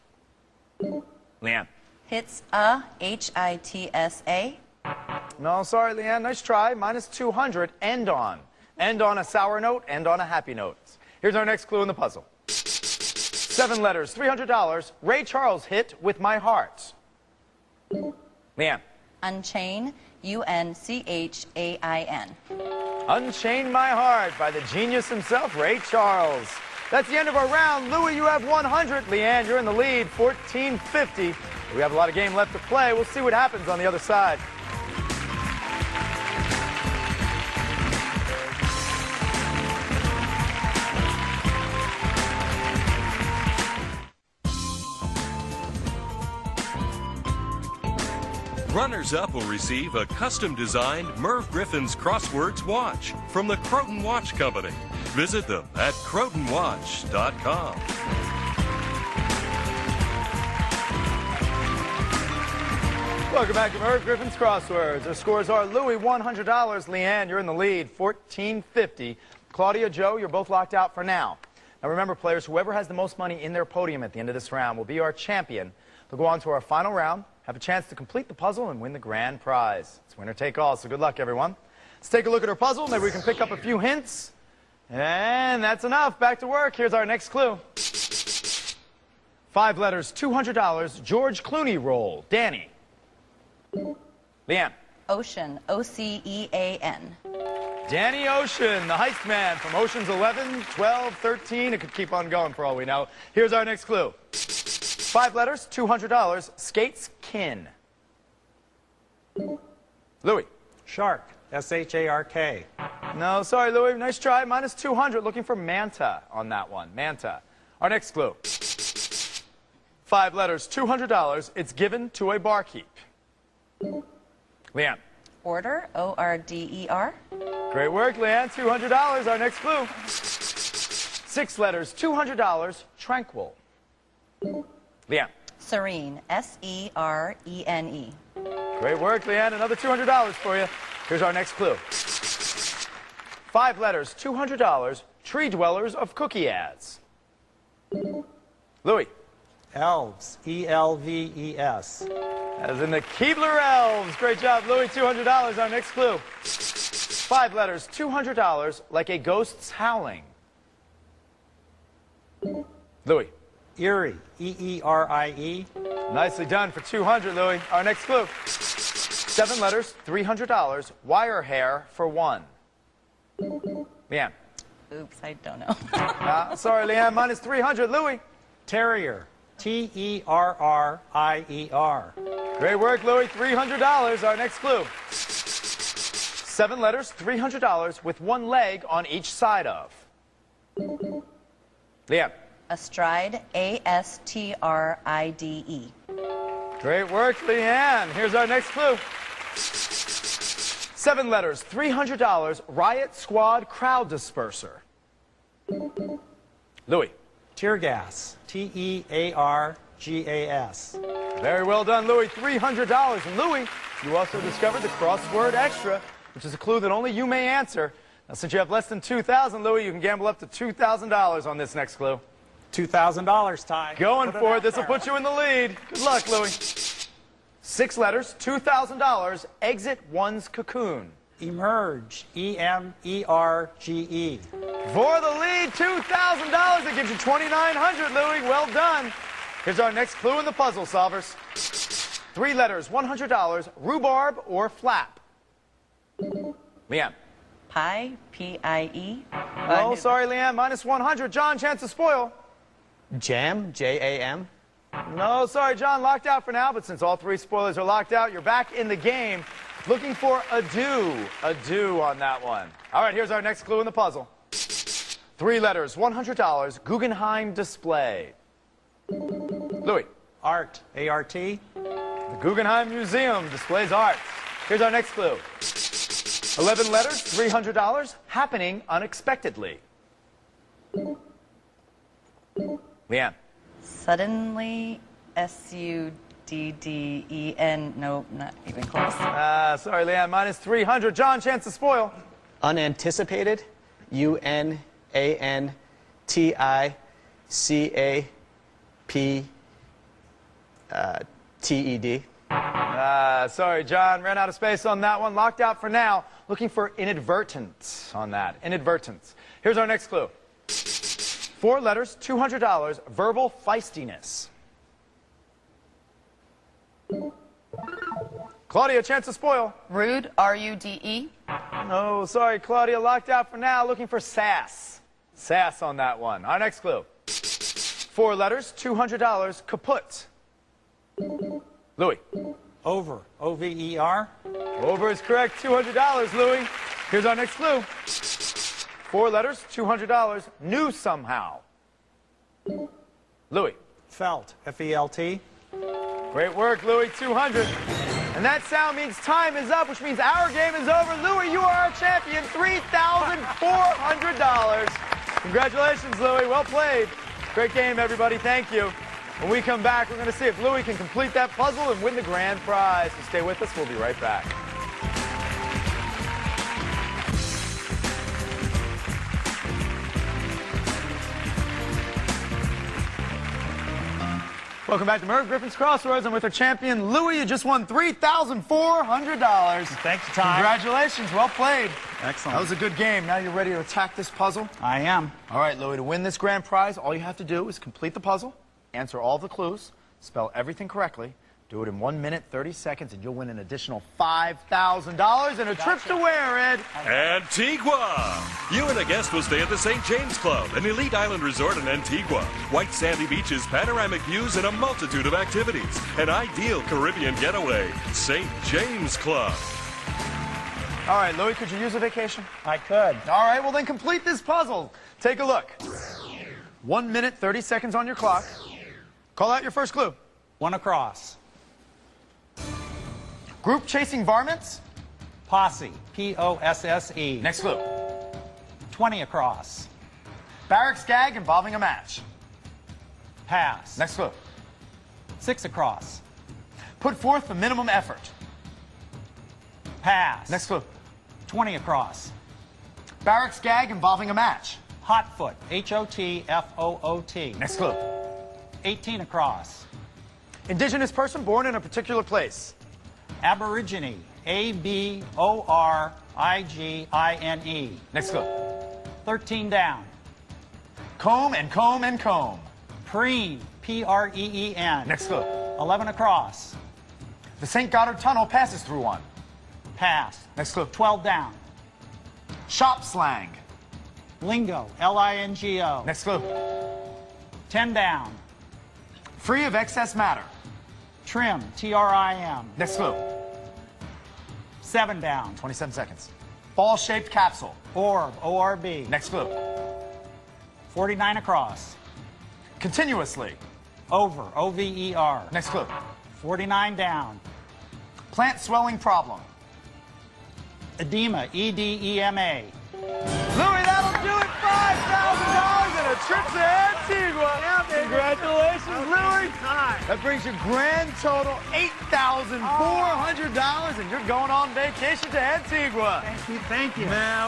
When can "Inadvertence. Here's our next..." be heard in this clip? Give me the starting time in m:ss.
5:08.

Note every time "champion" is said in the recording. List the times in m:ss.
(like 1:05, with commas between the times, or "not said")
1:15, 5:51, 6:16.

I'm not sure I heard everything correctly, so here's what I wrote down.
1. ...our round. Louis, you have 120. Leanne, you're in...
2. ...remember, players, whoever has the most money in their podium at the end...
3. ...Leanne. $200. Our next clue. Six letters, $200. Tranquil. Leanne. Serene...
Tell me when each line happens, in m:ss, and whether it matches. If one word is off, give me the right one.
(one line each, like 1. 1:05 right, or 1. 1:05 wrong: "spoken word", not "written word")
1. 0:27 wrong: "100", not "120"
2. 1:11 right
3. 2:08 right.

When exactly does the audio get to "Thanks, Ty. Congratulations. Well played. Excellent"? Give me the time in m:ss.
6:19.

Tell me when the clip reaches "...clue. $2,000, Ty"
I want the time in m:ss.
3:41.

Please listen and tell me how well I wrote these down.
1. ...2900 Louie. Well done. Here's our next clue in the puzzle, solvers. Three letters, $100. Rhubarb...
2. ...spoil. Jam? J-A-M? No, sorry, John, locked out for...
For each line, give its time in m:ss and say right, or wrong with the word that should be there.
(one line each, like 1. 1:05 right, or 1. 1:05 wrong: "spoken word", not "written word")
1. 3:57 right
2. 4:11 right.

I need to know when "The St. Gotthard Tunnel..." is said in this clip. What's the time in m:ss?
7:47.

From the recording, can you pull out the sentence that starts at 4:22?
All right, here's our next clue in the puzzle.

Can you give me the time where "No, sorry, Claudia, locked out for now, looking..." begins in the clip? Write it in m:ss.
5:21.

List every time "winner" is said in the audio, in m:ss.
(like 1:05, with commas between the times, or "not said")
1:20.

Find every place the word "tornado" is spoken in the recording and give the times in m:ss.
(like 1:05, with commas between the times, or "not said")
not said.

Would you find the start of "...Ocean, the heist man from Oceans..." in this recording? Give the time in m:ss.
1:38.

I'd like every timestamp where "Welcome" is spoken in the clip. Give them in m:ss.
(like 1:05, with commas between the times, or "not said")
1:03, 6:14.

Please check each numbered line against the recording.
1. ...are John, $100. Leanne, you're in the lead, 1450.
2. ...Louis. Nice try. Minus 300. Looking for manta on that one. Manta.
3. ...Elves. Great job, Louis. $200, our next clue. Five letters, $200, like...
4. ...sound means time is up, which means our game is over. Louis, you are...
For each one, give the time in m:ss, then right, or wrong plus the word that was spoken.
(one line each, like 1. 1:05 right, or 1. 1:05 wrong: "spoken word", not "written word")
1. 1:05 wrong: "Louis", not "John"
2. 1:53 wrong: "200", not "300"
3. 2:33 right
4. 5:48 right.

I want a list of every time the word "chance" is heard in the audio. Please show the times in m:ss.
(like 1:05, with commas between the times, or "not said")
1:17, 4:11, 4:51, 5:19.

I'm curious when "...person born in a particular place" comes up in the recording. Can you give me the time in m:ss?
7:31.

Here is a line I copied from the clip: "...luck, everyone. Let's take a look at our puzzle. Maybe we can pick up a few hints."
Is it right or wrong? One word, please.
right.